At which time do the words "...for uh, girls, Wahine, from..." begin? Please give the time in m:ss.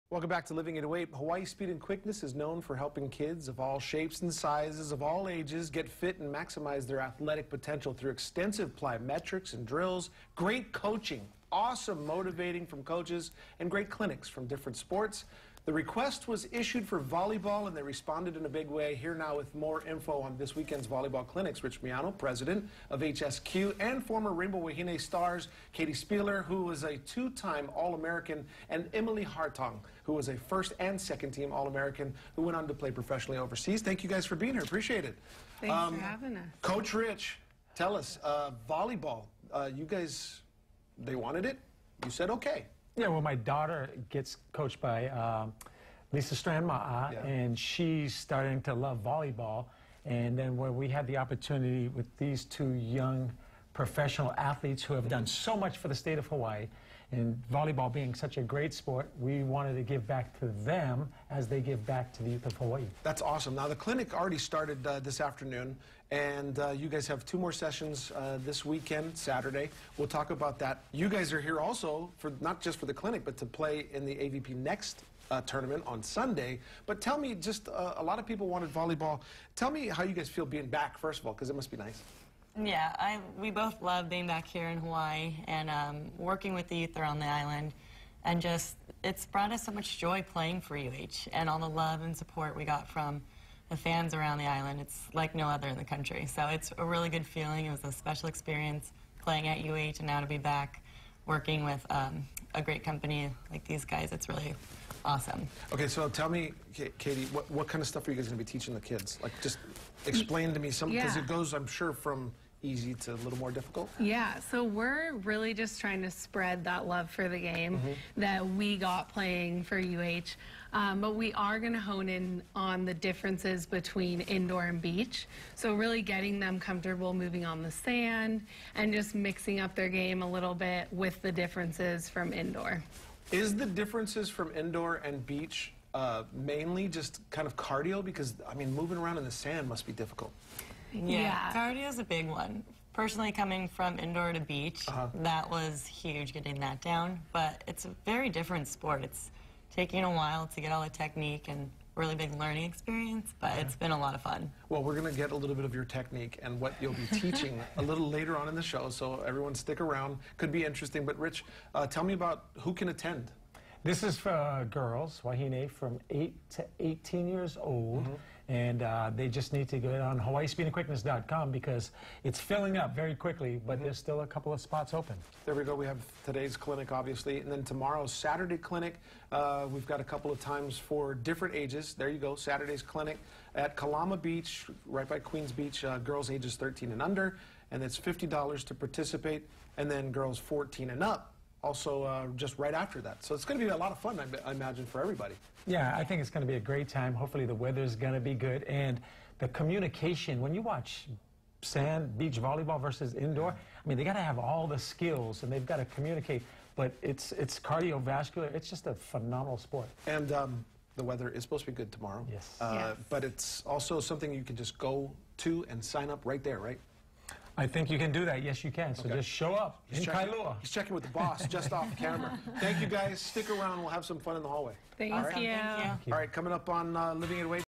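2:44.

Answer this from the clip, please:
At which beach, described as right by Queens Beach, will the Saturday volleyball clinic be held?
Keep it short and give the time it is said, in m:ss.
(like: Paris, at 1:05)
Kalama Beach, at 3:03.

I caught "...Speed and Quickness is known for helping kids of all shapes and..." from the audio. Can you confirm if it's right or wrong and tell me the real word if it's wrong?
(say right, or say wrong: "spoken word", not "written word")
right.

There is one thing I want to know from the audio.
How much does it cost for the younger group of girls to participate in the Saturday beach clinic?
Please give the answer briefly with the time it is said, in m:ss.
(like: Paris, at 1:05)
$50, at 3:07.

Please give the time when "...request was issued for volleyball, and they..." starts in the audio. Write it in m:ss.
0:15.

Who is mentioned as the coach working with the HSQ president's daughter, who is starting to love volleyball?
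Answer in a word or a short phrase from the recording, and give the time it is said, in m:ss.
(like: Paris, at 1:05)
Lisa Strand-Ma'a, at 0:46.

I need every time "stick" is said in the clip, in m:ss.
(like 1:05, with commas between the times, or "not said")
2:39, 3:43.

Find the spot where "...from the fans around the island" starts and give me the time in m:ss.
1:32.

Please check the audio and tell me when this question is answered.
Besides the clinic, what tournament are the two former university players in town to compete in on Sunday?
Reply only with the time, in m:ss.
1:14.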